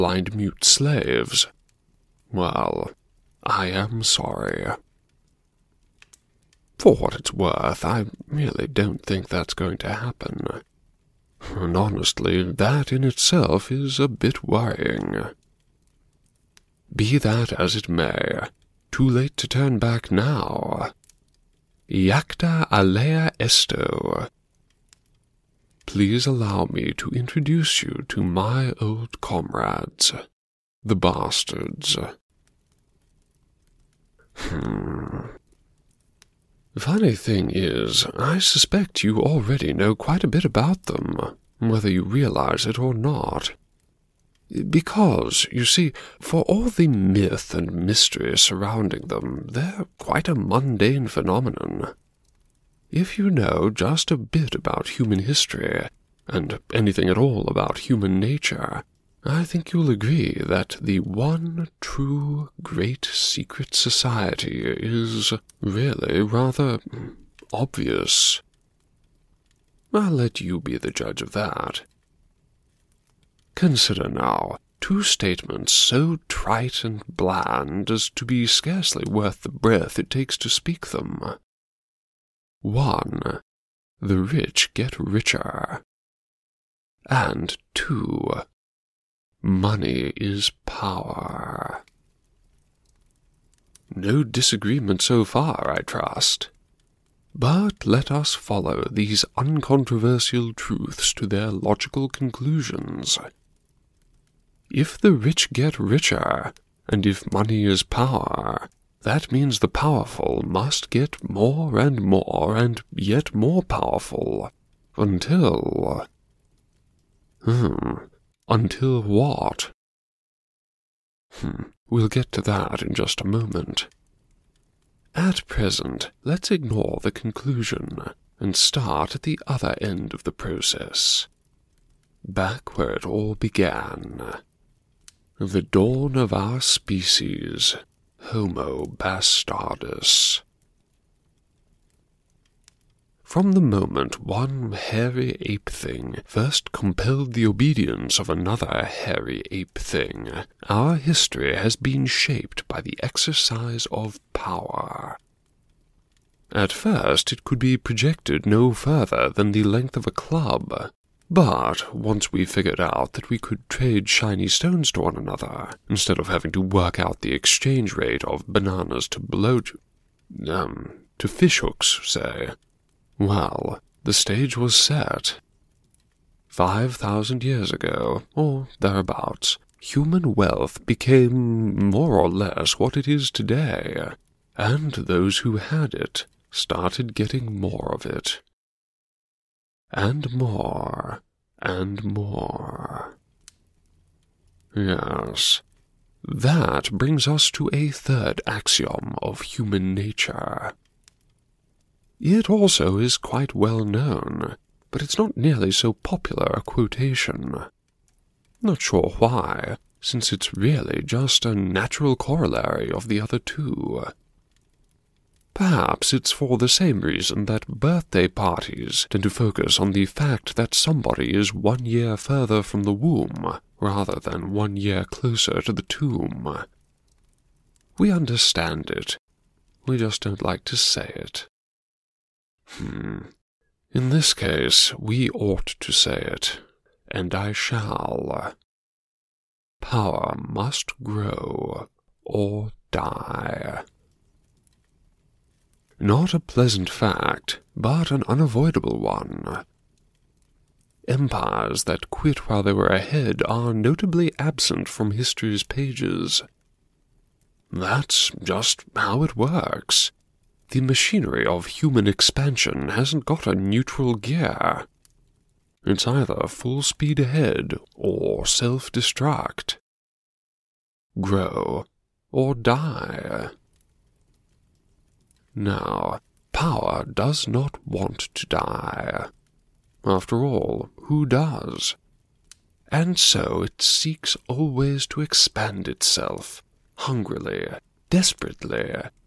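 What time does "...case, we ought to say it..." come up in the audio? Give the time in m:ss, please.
3:54.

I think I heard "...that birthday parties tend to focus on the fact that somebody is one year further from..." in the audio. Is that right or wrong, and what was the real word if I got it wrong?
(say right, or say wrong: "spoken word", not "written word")
right.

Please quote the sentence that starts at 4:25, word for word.
It's either full speed ahead or self destruct.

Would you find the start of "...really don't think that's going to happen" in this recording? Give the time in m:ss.
0:08.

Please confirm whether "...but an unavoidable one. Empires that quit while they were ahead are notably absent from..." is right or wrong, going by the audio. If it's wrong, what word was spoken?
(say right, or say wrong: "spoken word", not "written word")
right.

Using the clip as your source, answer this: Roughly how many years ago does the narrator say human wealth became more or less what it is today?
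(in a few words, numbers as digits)
5000.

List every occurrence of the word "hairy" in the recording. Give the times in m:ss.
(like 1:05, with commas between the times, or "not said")
2:24, 2:28.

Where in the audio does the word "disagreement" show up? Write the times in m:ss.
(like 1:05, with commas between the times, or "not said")
1:34.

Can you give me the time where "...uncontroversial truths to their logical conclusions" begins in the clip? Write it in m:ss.
1:39.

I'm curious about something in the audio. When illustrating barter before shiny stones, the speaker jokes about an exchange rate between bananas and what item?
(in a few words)
fishhooks.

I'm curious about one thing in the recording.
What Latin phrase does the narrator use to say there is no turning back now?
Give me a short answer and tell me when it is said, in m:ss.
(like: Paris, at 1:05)
Iacta alea esto, at 0:21.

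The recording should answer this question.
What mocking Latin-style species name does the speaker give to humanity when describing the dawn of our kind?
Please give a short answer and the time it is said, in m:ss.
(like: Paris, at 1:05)
Homo bastardus, at 2:18.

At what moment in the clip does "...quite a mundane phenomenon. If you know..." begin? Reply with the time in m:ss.
0:49.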